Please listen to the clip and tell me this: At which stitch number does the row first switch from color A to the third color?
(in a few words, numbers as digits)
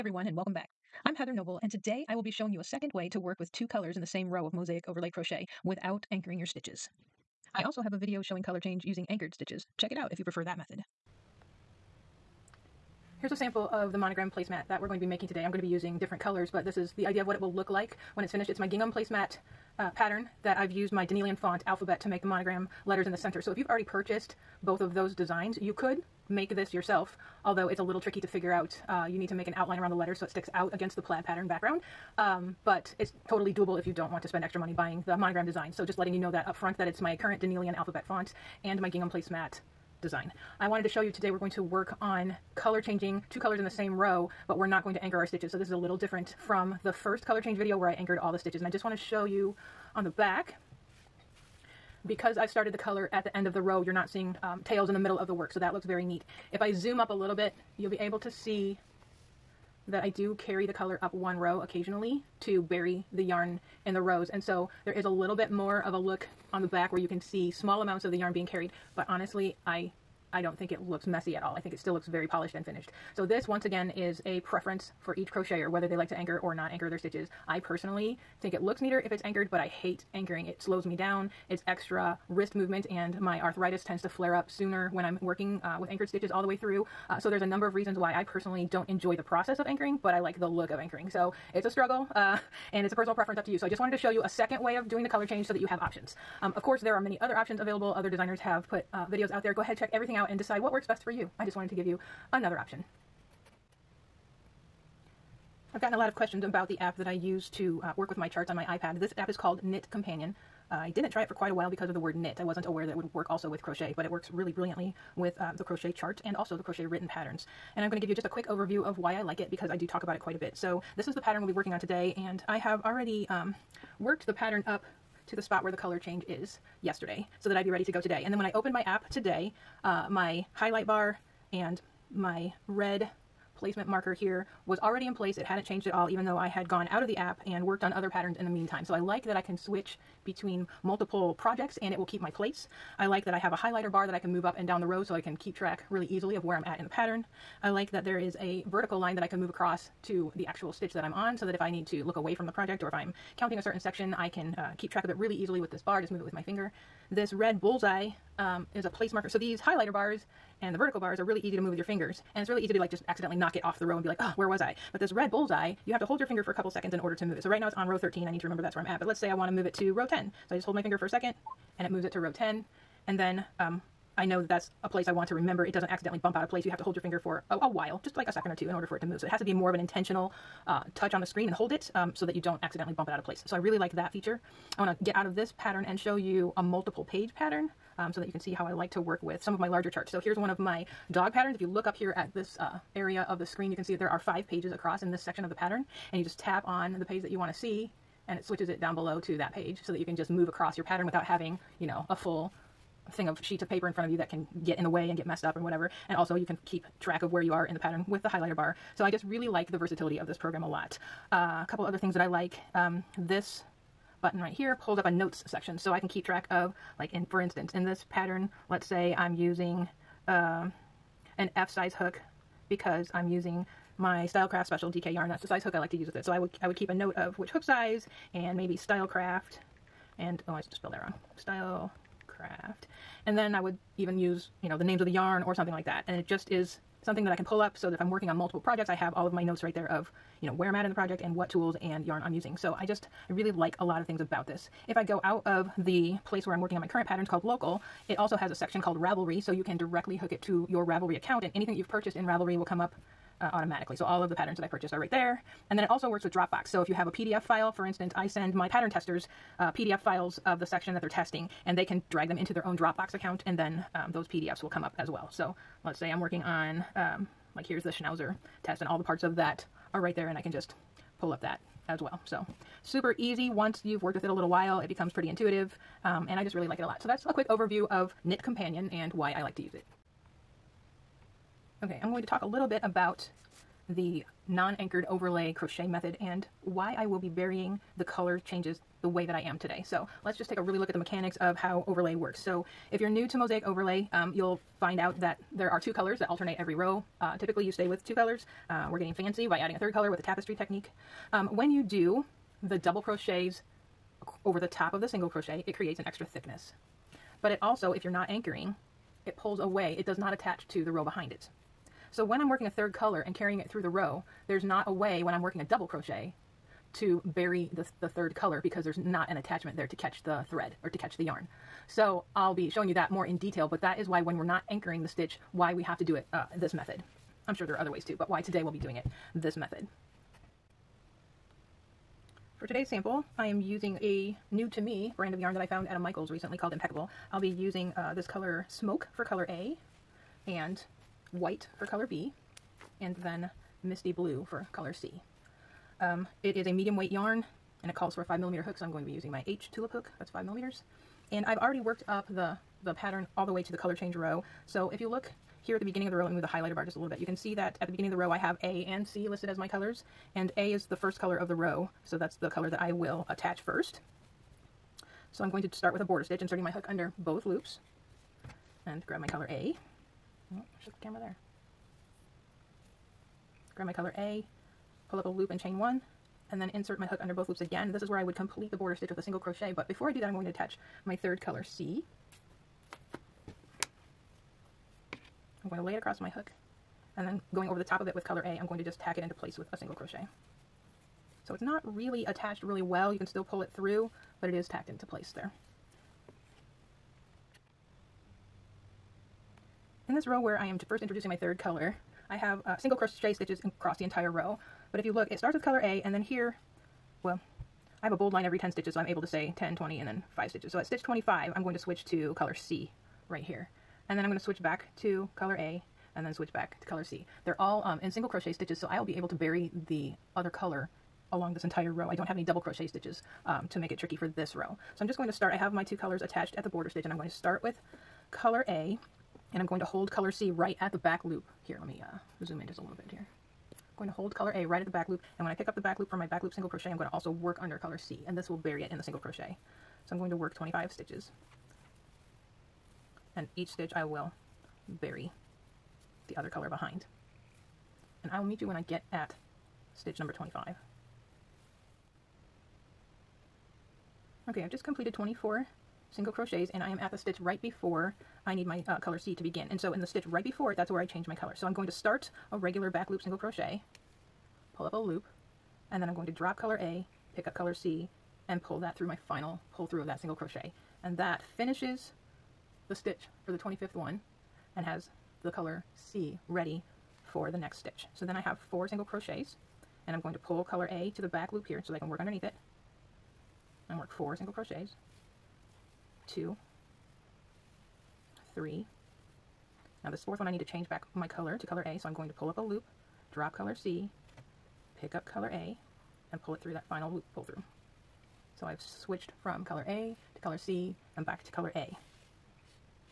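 25.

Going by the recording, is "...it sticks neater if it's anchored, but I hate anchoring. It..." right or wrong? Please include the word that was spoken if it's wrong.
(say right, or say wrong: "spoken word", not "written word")
wrong: "looks", not "sticks".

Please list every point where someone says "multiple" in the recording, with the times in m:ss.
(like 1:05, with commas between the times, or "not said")
2:20, 3:06, 3:58.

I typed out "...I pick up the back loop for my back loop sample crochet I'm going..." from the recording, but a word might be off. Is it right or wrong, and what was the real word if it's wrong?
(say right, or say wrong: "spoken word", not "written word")
wrong: "single", not "sample".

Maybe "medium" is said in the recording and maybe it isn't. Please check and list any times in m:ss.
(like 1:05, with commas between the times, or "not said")
5:46.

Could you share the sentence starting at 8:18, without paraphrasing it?
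So I've switched from color A to color C and back to color A.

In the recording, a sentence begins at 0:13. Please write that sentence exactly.
Here's a sample of the monogram placemat that we're going to be making today.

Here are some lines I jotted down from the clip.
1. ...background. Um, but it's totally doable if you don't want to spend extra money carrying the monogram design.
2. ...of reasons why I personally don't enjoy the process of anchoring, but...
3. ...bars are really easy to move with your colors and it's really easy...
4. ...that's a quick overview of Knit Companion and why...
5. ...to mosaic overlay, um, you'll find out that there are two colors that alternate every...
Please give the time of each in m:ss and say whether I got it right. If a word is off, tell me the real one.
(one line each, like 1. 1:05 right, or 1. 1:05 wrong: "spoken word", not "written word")
1. 0:31 wrong: "buying", not "carrying"
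2. 1:27 right
3. 2:40 wrong: "fingers", not "colors"
4. 4:37 right
5. 4:53 right.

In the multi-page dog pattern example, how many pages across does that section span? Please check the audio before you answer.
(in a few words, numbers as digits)
5.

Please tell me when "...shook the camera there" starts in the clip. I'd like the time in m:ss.
6:10.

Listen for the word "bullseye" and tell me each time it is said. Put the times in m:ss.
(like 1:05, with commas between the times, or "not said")
2:37, 2:45.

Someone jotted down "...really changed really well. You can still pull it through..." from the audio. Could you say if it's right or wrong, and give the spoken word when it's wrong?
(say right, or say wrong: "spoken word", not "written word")
wrong: "attached", not "changed".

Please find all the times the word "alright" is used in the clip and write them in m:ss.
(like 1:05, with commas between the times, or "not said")
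not said.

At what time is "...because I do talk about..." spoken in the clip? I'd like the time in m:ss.
1:59.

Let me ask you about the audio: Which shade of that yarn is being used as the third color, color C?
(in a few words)
Misty Blue.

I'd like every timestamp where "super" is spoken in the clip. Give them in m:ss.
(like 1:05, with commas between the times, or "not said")
4:32.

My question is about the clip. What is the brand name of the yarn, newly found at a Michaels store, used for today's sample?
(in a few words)
Impeccable.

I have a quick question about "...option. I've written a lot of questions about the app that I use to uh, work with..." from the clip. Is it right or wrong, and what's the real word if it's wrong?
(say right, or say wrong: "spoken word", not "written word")
wrong: "gotten", not "written".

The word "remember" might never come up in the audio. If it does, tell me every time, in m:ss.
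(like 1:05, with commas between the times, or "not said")
2:48, 2:55.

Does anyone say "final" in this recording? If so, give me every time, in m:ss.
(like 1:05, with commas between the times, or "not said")
7:49, 8:16.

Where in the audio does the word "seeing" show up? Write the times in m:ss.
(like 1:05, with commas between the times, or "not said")
0:54.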